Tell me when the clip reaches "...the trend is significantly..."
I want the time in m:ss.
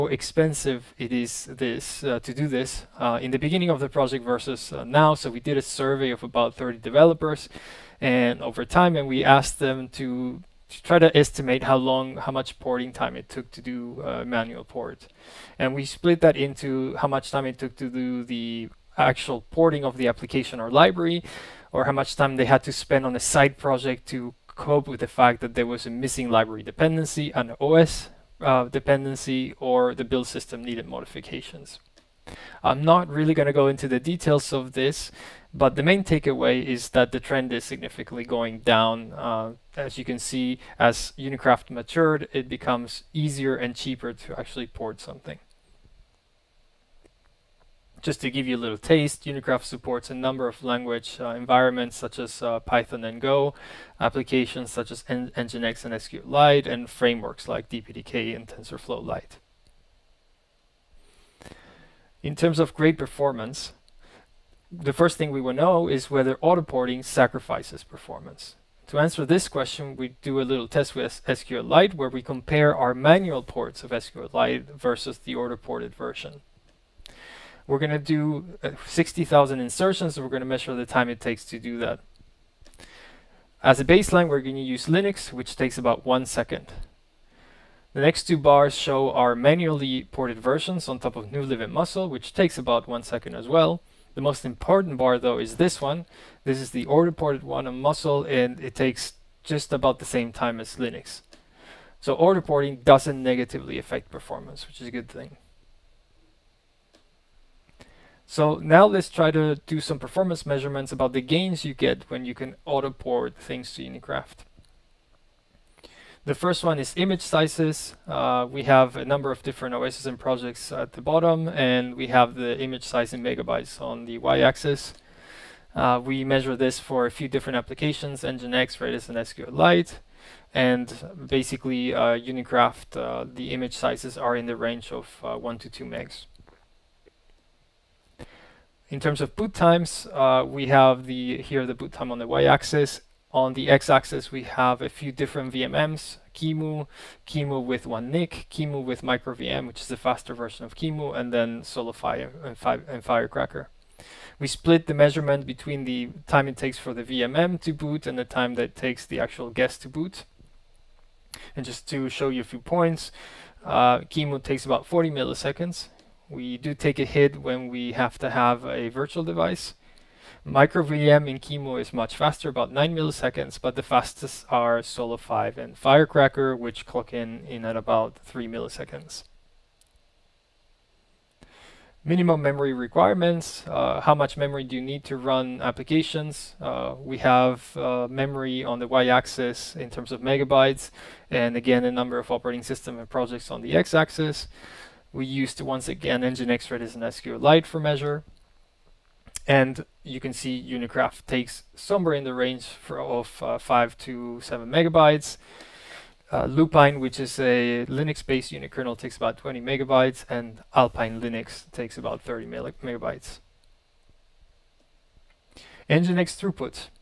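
0:37.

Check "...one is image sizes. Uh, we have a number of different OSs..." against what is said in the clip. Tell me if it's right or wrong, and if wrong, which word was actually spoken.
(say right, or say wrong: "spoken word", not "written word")
right.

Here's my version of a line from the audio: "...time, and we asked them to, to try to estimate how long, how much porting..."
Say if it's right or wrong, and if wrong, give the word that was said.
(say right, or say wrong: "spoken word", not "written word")
right.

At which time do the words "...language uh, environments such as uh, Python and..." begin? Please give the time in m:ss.
0:50.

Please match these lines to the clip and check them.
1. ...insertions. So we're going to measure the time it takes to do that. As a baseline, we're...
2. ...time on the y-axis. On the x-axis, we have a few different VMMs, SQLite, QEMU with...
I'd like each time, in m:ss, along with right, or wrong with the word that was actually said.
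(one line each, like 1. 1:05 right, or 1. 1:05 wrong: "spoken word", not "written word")
1. 1:19 right
2. 2:21 wrong: "QEMU", not "SQLite".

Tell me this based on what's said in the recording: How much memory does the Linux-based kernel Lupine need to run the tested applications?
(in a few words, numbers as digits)
20 megabytes.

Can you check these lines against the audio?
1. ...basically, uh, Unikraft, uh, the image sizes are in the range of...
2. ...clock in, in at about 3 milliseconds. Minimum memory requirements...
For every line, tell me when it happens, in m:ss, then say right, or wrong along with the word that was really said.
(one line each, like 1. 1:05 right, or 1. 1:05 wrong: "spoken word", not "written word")
1. 2:11 right
2. 2:56 right.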